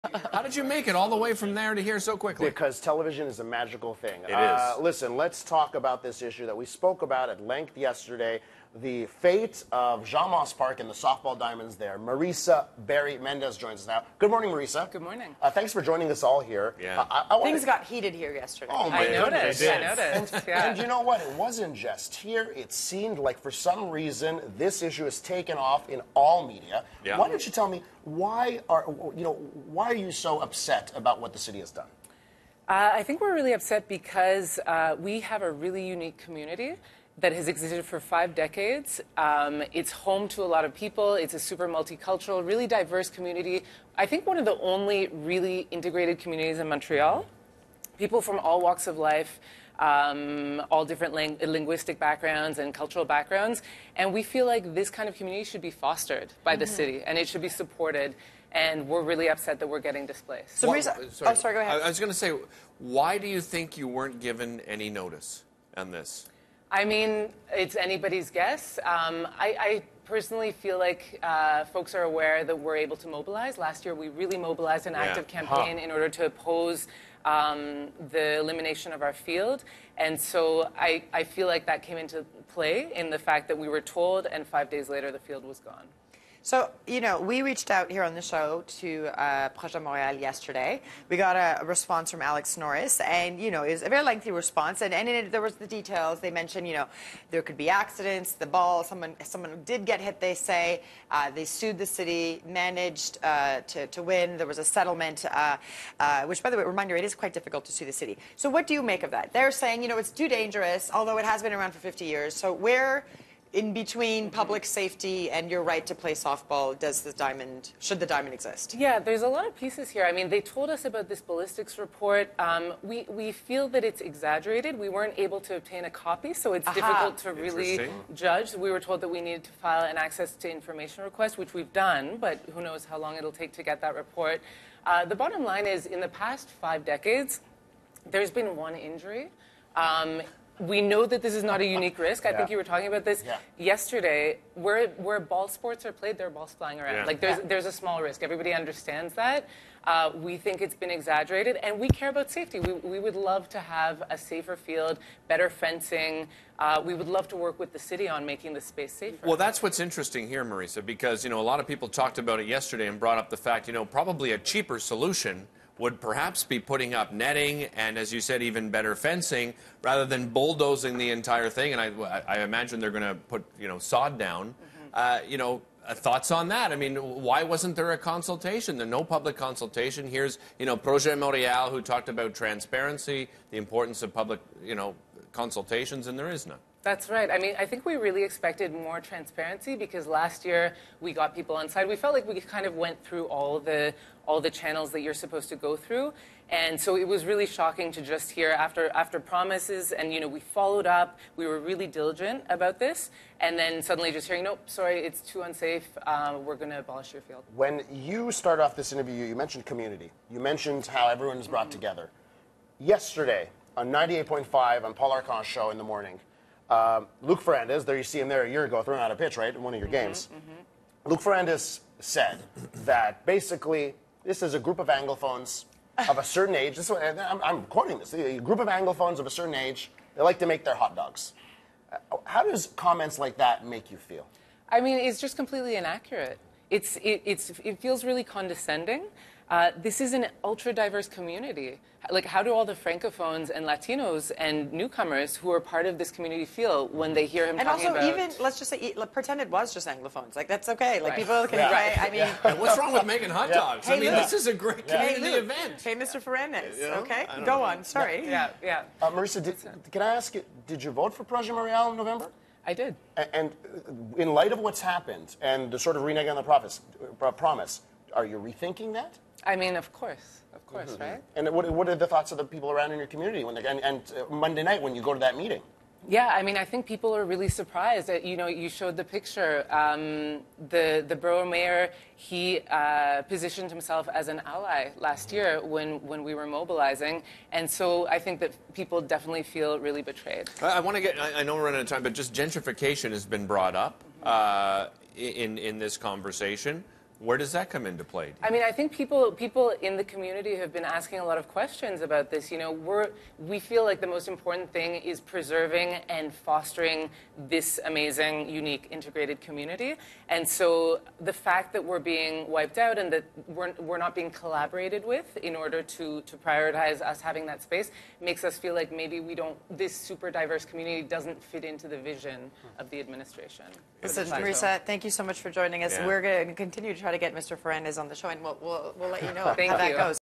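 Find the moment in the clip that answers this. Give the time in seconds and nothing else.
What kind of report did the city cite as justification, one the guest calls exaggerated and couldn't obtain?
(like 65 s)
121 s.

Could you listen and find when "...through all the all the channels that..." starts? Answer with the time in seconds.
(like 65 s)
193 s.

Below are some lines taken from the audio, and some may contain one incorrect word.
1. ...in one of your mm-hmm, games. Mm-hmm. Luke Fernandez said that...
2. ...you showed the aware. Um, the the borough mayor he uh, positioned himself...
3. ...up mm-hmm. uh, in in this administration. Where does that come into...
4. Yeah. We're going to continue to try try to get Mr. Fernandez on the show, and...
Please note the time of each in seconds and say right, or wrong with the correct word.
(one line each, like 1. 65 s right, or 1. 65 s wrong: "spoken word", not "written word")
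1. 219 s right
2. 278 s wrong: "picture", not "aware"
3. 293 s wrong: "conversation", not "administration"
4. 325 s right.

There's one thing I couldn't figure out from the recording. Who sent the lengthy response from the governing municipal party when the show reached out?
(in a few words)
Alex Norris.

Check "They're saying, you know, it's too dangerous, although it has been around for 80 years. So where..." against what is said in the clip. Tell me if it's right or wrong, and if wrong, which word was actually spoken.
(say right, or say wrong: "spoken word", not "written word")
wrong: "50", not "80".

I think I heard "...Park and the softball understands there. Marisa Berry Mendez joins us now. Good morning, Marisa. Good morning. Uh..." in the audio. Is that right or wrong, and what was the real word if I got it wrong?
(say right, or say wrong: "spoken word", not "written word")
wrong: "diamonds", not "understands".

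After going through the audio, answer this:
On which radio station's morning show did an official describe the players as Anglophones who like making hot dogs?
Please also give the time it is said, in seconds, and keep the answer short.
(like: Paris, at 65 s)
98.5, at 213 s.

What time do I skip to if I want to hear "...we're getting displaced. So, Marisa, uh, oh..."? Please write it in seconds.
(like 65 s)
59 s.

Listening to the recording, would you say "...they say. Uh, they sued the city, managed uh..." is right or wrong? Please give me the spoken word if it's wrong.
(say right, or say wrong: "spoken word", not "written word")
right.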